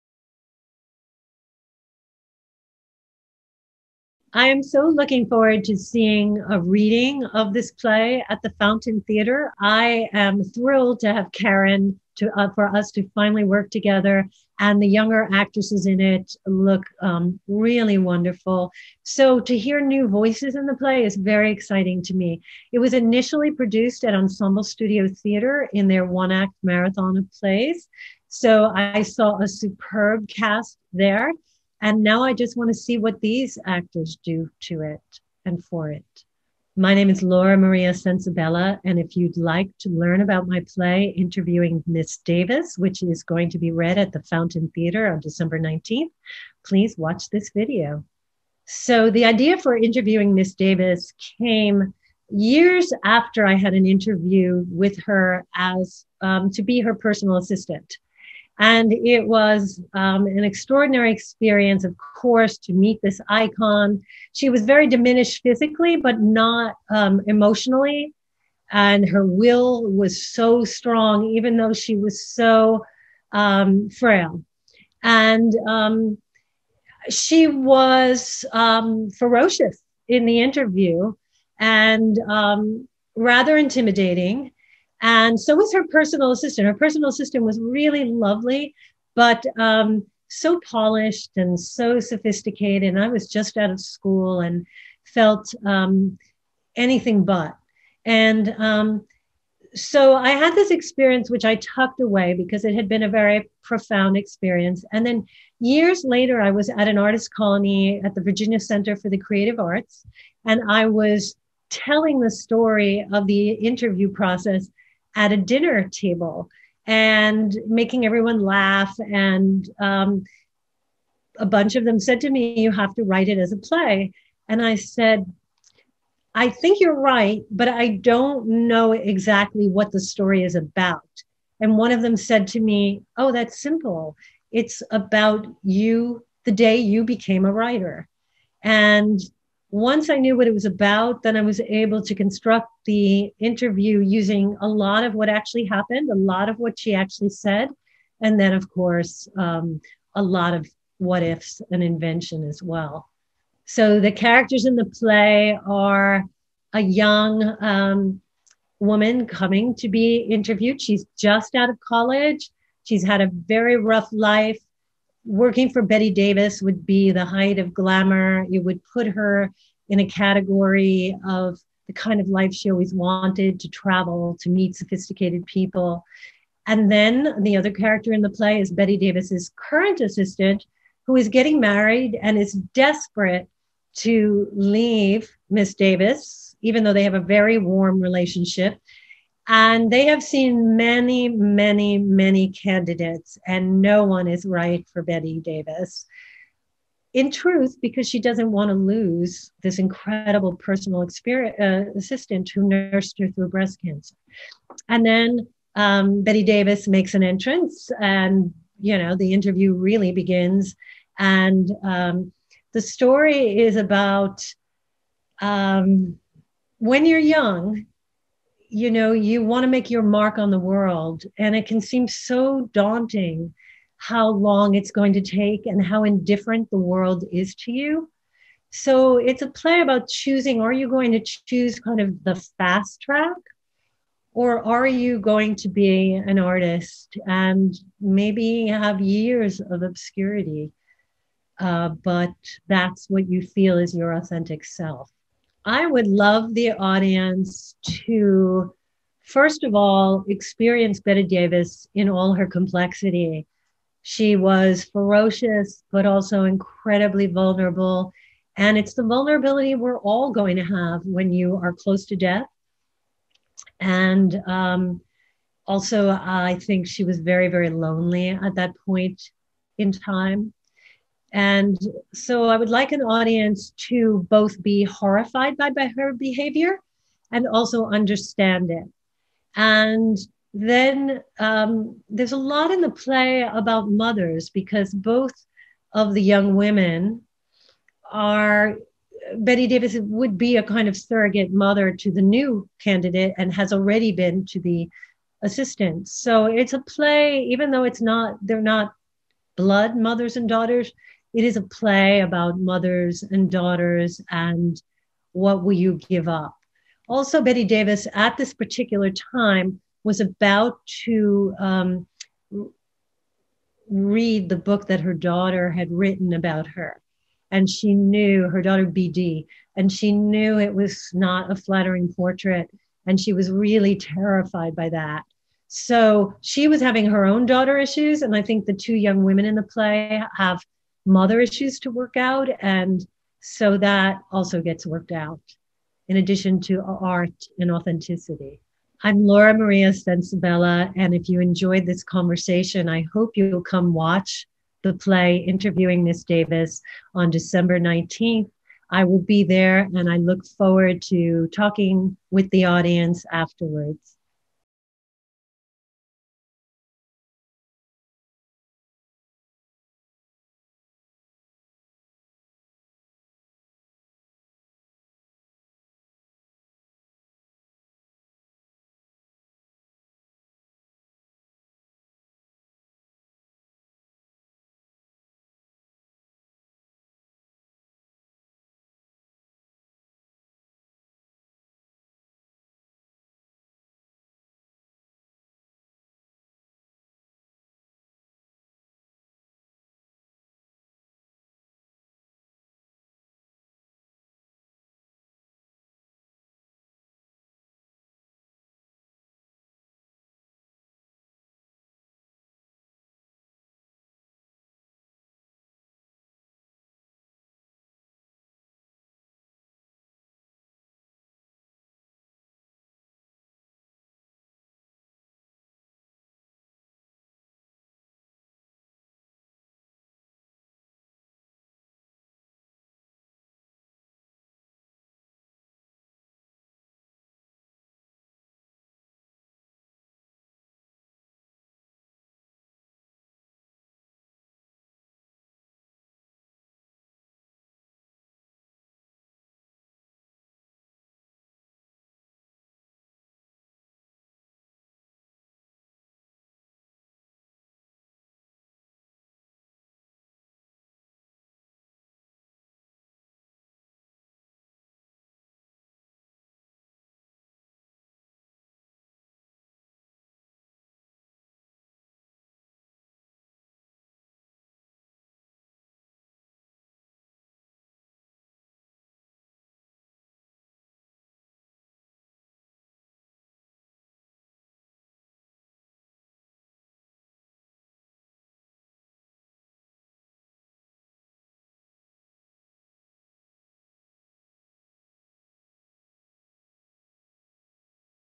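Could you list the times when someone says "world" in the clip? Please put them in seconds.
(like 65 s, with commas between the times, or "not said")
220 s, 226 s.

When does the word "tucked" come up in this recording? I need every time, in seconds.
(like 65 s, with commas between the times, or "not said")
101 s.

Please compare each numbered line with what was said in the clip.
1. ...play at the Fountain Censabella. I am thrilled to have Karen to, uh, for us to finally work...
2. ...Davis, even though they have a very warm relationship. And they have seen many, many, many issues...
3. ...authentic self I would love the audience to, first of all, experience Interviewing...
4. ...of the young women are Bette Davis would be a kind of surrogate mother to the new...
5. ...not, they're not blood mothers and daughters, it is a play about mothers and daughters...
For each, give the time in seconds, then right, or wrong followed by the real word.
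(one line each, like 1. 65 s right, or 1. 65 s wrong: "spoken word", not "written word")
1. 7 s wrong: "Theater", not "Censabella"
2. 185 s wrong: "candidates", not "issues"
3. 244 s wrong: "Bette", not "Interviewing"
4. 285 s right
5. 298 s right.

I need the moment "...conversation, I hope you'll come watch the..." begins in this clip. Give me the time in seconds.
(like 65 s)
342 s.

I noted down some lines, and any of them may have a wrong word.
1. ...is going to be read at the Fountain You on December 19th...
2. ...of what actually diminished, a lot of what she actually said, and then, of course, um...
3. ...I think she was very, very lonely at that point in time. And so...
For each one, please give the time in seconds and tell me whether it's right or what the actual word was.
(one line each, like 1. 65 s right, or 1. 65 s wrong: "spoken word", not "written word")
1. 43 s wrong: "Theater", not "You"
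2. 145 s wrong: "happened", not "diminished"
3. 266 s right.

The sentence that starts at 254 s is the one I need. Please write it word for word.
She was ferocious, but also incredibly vulnerable.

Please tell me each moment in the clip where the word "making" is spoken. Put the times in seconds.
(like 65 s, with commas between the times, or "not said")
117 s.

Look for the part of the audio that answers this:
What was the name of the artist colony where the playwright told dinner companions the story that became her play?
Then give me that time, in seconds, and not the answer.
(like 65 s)
108 s.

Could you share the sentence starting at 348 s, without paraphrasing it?
I will be there, and I look forward to talking with the audience afterwards.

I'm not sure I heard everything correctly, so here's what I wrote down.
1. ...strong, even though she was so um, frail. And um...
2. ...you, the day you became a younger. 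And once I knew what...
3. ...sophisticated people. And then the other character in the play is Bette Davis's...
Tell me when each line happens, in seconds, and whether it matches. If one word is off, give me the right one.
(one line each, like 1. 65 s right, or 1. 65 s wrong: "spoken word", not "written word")
1. 70 s right
2. 135 s wrong: "writer", not "younger"
3. 174 s right.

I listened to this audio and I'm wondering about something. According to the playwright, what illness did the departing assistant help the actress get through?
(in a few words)
breast cancer.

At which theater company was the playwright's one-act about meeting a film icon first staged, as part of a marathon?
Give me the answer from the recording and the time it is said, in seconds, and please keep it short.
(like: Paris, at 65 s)
Ensemble Studio Theater, at 24 s.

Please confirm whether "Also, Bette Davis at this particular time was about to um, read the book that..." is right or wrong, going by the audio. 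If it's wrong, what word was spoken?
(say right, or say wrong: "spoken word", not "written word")
right.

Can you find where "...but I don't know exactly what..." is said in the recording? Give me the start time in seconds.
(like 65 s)
127 s.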